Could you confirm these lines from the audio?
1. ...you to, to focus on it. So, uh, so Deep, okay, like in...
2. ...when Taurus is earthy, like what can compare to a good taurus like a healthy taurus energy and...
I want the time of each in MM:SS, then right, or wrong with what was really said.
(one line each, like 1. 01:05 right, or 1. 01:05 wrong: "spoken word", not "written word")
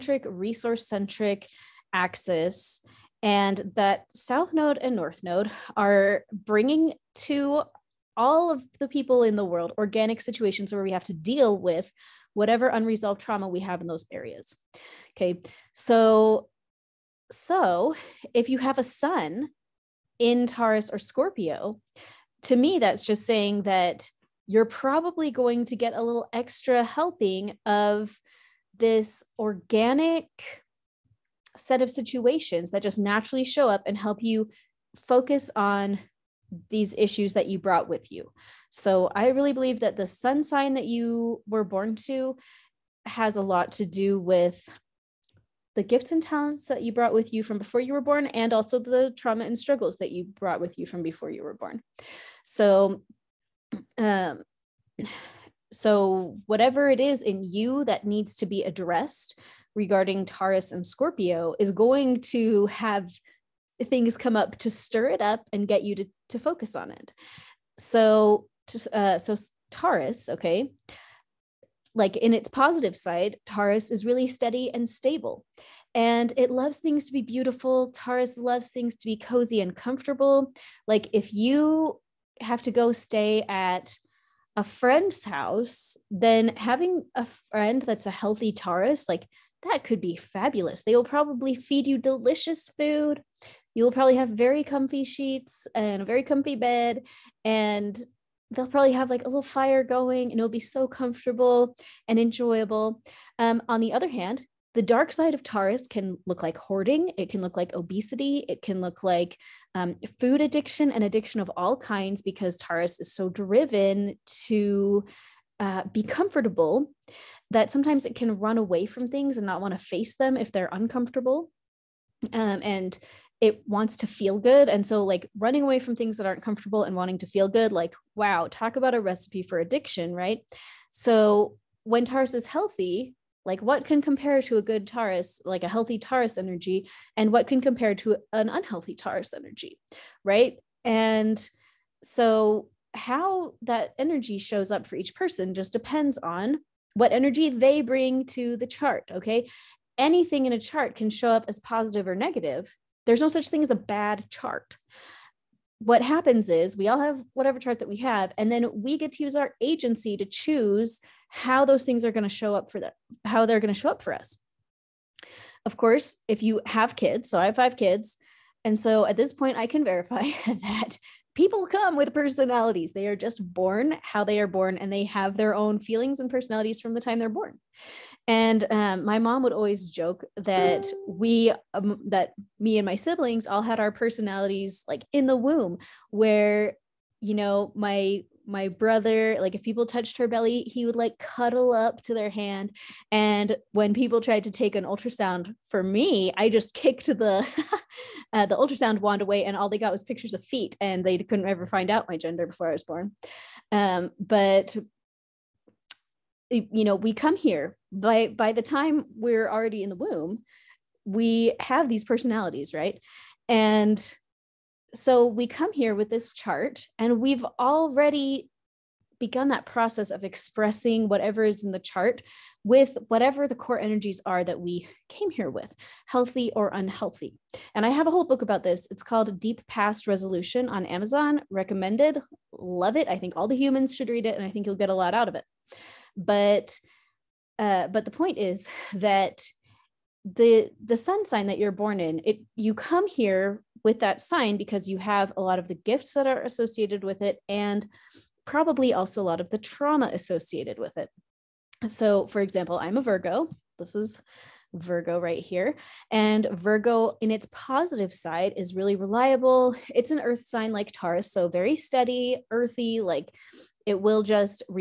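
1. 01:05 wrong: "Taurus", not "Deep"
2. 02:11 wrong: "healthy", not "earthy".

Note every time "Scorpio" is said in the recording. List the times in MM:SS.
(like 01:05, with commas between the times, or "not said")
00:20, 01:00.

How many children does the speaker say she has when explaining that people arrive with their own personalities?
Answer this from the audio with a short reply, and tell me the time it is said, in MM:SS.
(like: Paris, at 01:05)
5, at 02:47.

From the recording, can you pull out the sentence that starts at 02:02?
Um, and it wants to feel good.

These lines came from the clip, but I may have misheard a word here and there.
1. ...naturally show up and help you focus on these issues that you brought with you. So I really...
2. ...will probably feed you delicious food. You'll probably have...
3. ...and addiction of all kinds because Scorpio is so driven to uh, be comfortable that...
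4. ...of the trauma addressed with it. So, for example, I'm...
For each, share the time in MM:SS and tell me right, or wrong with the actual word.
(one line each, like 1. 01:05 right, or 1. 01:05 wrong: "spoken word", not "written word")
1. 00:32 right
2. 01:30 right
3. 01:50 wrong: "Taurus", not "Scorpio"
4. 04:09 wrong: "associated", not "addressed".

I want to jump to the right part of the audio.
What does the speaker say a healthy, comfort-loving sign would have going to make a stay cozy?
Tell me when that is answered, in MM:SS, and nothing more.
01:39.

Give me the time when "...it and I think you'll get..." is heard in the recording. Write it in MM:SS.
03:54.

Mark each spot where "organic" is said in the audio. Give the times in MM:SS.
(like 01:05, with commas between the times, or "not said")
00:09, 00:29.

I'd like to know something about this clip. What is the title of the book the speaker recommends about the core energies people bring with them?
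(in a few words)
Deep Past Resolution.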